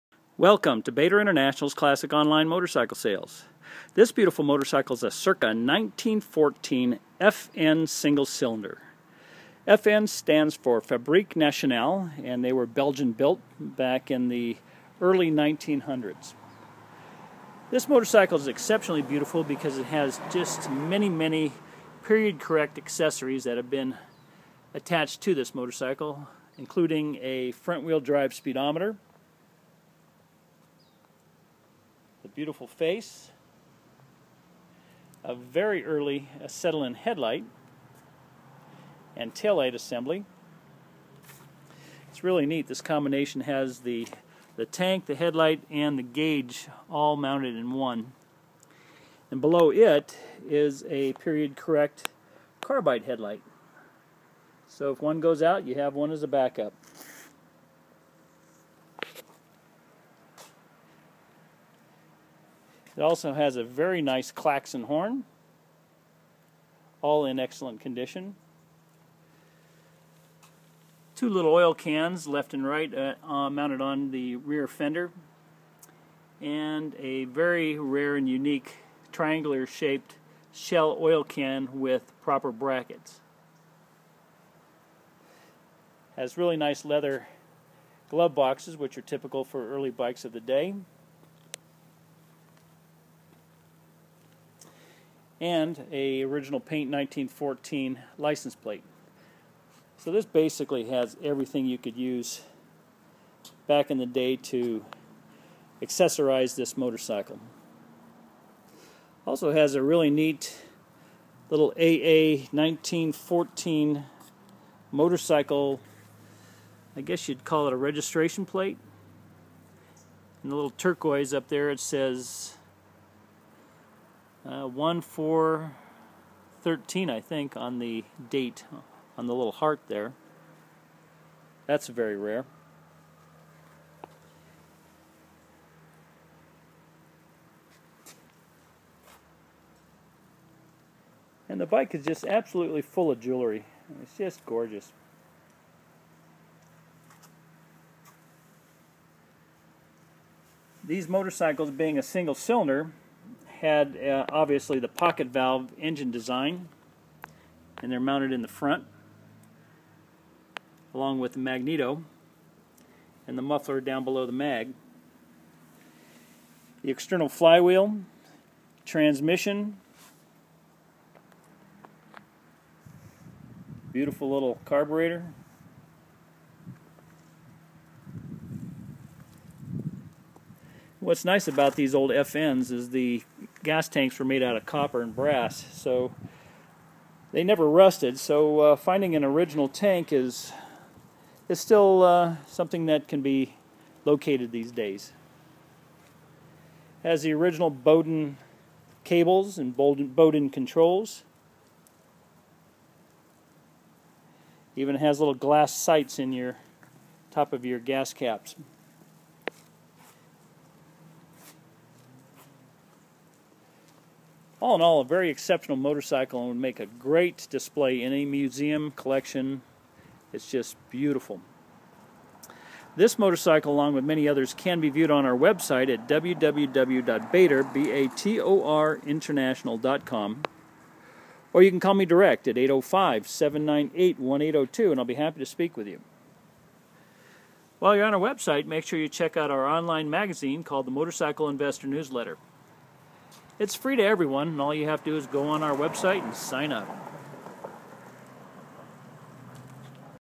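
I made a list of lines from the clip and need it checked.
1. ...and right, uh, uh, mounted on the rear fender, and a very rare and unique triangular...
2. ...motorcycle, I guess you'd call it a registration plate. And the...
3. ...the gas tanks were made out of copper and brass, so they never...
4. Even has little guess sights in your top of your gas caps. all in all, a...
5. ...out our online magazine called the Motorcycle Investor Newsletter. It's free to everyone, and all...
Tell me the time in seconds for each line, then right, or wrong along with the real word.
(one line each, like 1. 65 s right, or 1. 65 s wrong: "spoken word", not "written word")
1. 72 s right
2. 114 s right
3. 182 s right
4. 204 s wrong: "glass", not "guess"
5. 239 s right.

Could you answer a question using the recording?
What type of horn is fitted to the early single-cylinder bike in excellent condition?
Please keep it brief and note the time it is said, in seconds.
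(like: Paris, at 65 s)
Klaxon, at 64 s.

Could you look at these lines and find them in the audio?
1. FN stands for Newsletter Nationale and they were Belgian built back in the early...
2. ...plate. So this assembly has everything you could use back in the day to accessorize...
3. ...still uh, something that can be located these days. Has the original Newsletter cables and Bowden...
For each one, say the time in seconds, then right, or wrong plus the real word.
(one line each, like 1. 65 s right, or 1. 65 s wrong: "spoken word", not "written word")
1. 9 s wrong: "Fabrique", not "Newsletter"
2. 98 s wrong: "basically", not "assembly"
3. 191 s wrong: "Bowden", not "Newsletter".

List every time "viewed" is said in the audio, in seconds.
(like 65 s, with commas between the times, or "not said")
224 s.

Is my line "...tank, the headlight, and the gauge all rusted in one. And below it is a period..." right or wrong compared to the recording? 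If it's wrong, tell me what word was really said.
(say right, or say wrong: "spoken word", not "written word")
wrong: "mounted", not "rusted".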